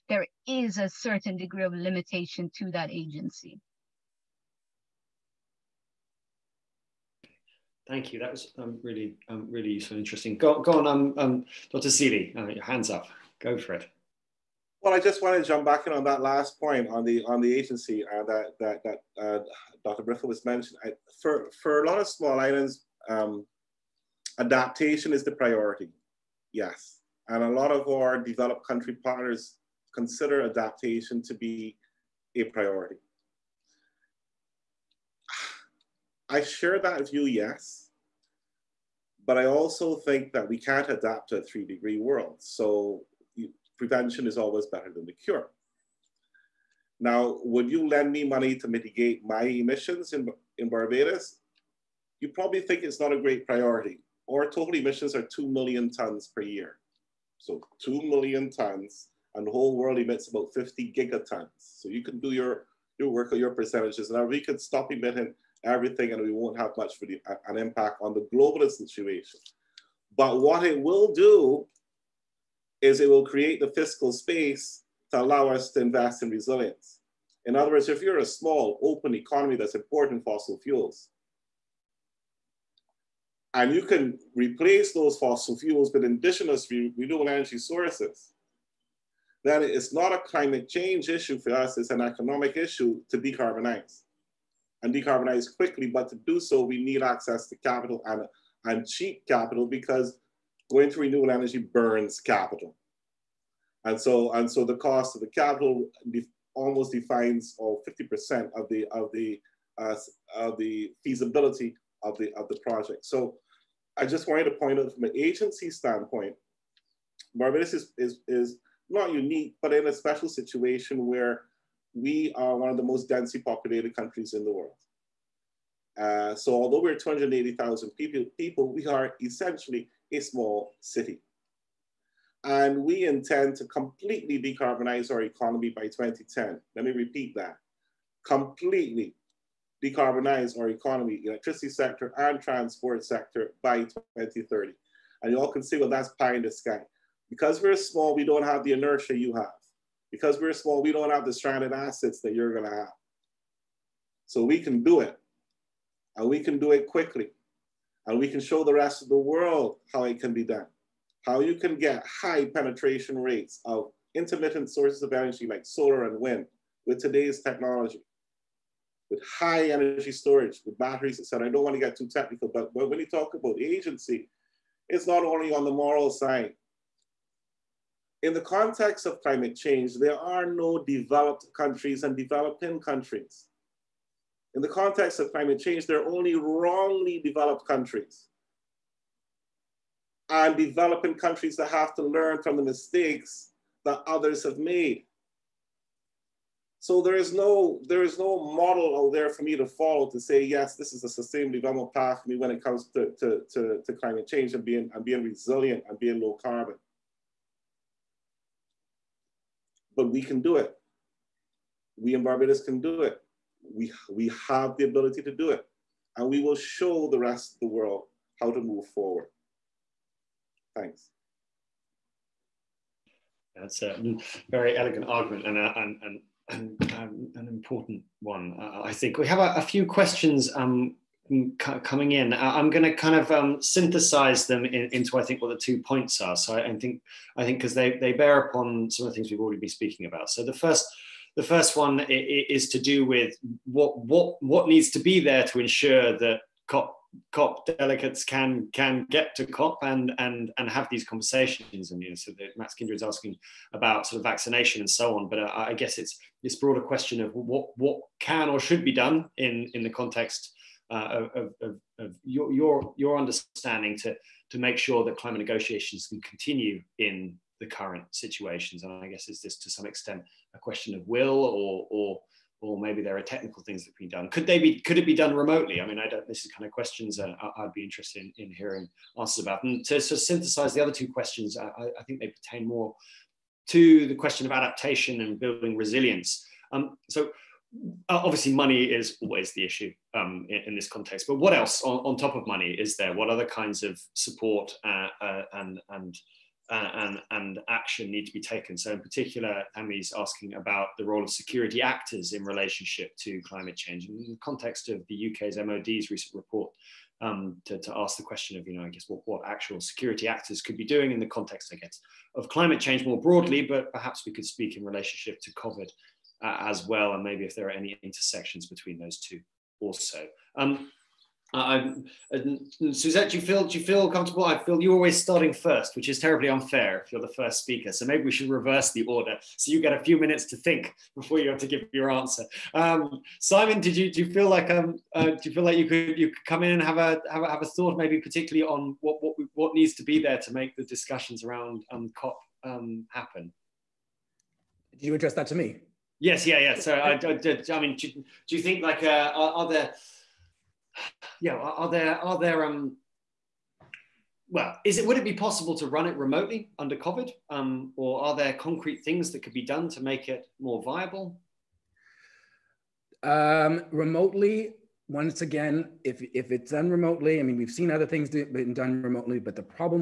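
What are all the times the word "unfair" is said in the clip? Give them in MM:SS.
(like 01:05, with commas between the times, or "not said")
05:26.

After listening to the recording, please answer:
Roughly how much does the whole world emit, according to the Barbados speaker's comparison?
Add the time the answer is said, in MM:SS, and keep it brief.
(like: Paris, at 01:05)
50 gigatons, at 01:00.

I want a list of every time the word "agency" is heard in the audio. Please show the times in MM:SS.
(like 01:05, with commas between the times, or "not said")
00:02, 00:17, 01:55, 02:53.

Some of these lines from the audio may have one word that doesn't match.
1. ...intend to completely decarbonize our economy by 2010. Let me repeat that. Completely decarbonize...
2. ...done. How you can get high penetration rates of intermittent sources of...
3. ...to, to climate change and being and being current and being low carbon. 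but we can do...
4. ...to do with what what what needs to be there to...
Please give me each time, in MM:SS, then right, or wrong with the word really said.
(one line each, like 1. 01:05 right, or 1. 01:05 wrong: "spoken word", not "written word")
1. 02:13 right
2. 02:40 right
3. 03:23 wrong: "resilient", not "current"
4. 04:02 right.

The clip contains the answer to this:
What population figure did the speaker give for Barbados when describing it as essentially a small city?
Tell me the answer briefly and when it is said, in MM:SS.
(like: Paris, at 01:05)
280,000, at 02:06.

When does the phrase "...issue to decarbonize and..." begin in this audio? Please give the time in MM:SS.
01:32.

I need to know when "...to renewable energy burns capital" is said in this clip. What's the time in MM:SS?
01:40.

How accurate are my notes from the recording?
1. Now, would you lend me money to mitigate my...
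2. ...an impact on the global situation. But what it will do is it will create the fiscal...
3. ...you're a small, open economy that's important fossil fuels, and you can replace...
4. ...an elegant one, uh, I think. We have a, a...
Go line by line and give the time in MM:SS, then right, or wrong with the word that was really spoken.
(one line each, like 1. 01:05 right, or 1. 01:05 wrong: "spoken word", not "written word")
1. 00:47 right
2. 01:07 right
3. 01:18 right
4. 03:47 wrong: "important", not "elegant".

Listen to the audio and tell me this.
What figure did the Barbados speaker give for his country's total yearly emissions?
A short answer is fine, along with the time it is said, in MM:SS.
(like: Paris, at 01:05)
2 million tons, at 00:55.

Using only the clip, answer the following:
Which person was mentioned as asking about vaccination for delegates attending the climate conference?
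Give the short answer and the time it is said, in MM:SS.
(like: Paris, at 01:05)
Max Kinder, at 04:12.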